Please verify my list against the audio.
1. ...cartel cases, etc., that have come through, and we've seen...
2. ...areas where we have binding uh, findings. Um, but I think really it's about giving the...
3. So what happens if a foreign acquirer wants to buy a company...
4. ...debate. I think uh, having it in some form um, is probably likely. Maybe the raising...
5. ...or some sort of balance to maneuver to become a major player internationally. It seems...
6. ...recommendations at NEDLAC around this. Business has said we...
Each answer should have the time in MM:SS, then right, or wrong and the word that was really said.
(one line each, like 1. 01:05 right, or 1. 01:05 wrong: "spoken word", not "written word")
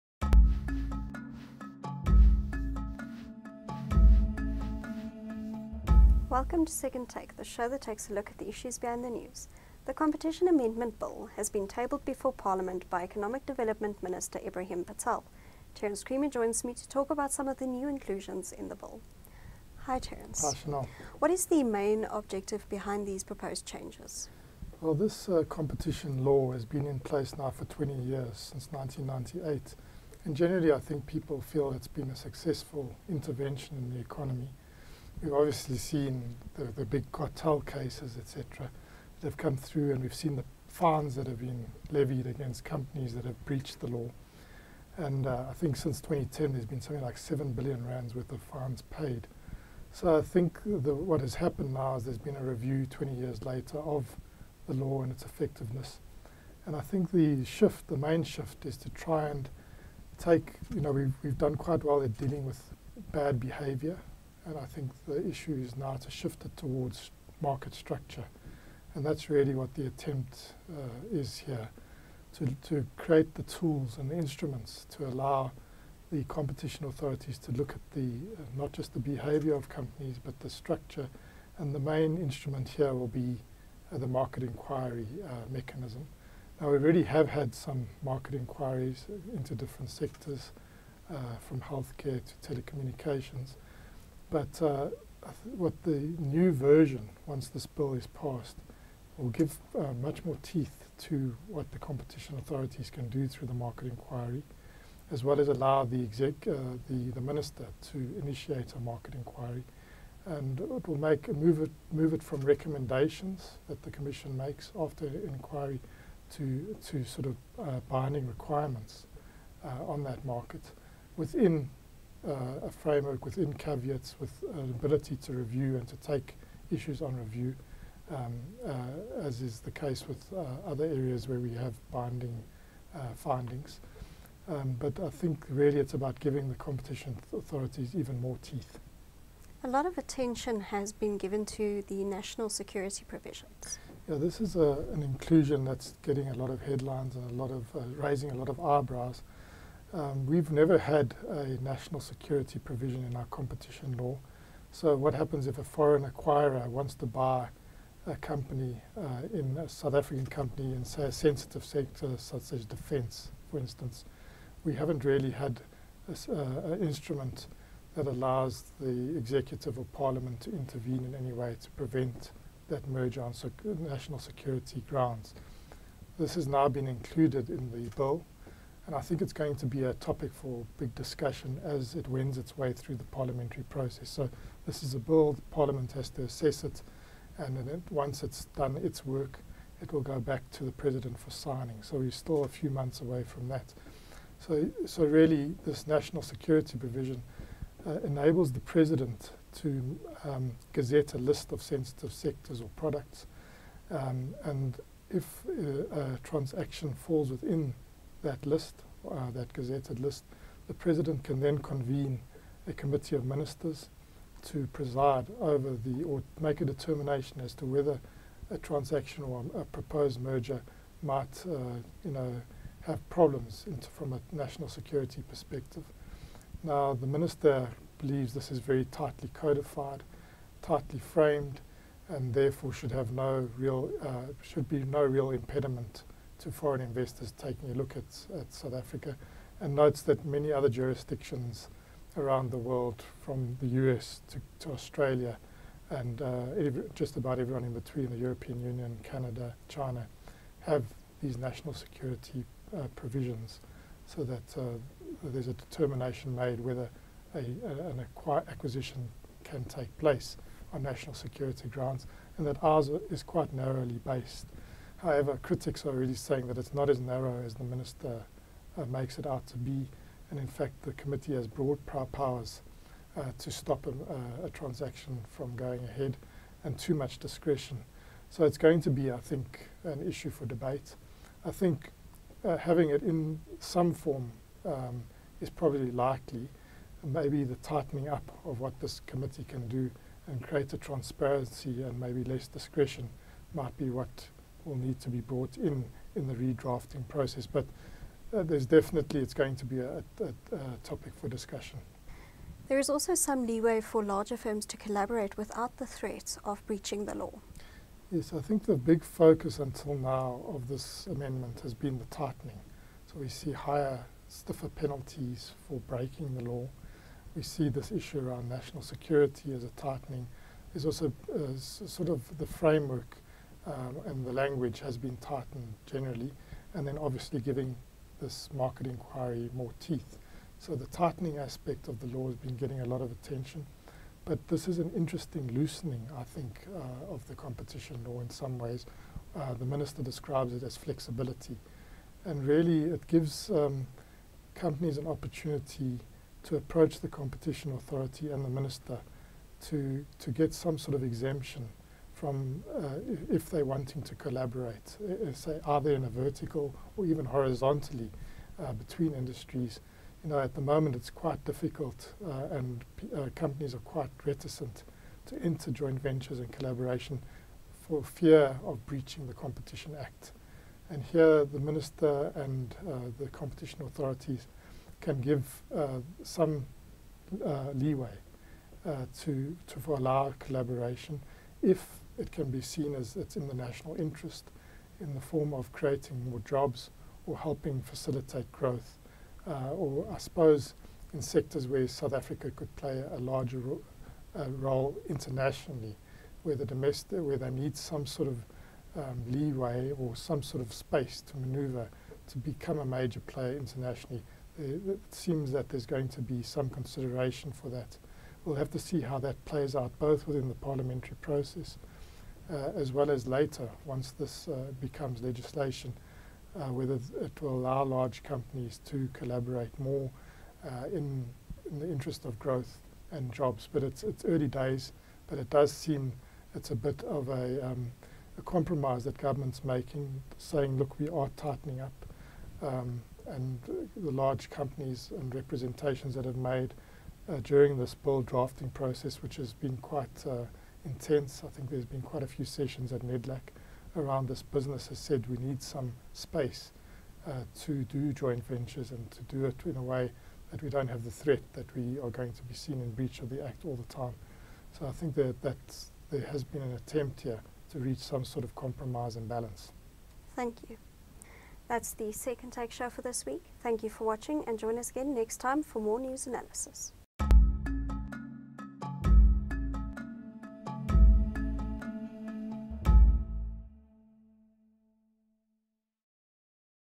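1. 00:37 right
2. 02:10 right
3. 02:34 right
4. 04:40 wrong: "tightening", not "raising"
5. 06:39 wrong: "space", not "balance"
6. 07:22 wrong: "sessions", not "recommendations".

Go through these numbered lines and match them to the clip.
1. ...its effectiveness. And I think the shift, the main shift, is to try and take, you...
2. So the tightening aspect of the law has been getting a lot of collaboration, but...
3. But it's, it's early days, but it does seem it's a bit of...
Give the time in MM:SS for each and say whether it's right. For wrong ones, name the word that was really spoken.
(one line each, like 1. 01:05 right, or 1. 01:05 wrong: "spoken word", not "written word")
1. 00:55 right
2. 05:30 wrong: "attention", not "collaboration"
3. 07:03 right.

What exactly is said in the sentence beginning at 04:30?
And in fact, the committee has broad powers uh, to stop a, uh, a, transaction from going ahead and too much discretion.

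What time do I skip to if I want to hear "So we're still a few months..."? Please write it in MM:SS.
03:11.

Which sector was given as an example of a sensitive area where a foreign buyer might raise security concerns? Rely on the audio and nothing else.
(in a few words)
defence.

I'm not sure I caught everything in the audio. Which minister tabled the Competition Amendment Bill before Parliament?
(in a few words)
Ibrahim Patel.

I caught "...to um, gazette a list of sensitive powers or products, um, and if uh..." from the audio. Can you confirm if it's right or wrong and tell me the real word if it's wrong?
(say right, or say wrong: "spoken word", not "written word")
wrong: "sectors", not "powers".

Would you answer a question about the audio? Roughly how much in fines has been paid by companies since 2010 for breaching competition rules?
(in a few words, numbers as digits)
7 billion rands.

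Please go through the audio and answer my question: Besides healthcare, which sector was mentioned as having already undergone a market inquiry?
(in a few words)
telecommunications.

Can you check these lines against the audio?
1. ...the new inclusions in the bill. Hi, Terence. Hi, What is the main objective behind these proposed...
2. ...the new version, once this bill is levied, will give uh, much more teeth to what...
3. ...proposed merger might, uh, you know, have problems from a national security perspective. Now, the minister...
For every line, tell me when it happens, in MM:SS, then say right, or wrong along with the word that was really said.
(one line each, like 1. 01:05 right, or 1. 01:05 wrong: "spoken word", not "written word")
1. 00:17 right
2. 01:35 wrong: "passed", not "levied"
3. 03:39 right.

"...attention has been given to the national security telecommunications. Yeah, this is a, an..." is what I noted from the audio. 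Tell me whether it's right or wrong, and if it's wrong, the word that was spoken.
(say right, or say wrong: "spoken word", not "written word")
wrong: "provisions", not "telecommunications".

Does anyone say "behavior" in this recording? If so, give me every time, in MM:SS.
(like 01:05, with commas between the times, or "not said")
01:03, 01:18.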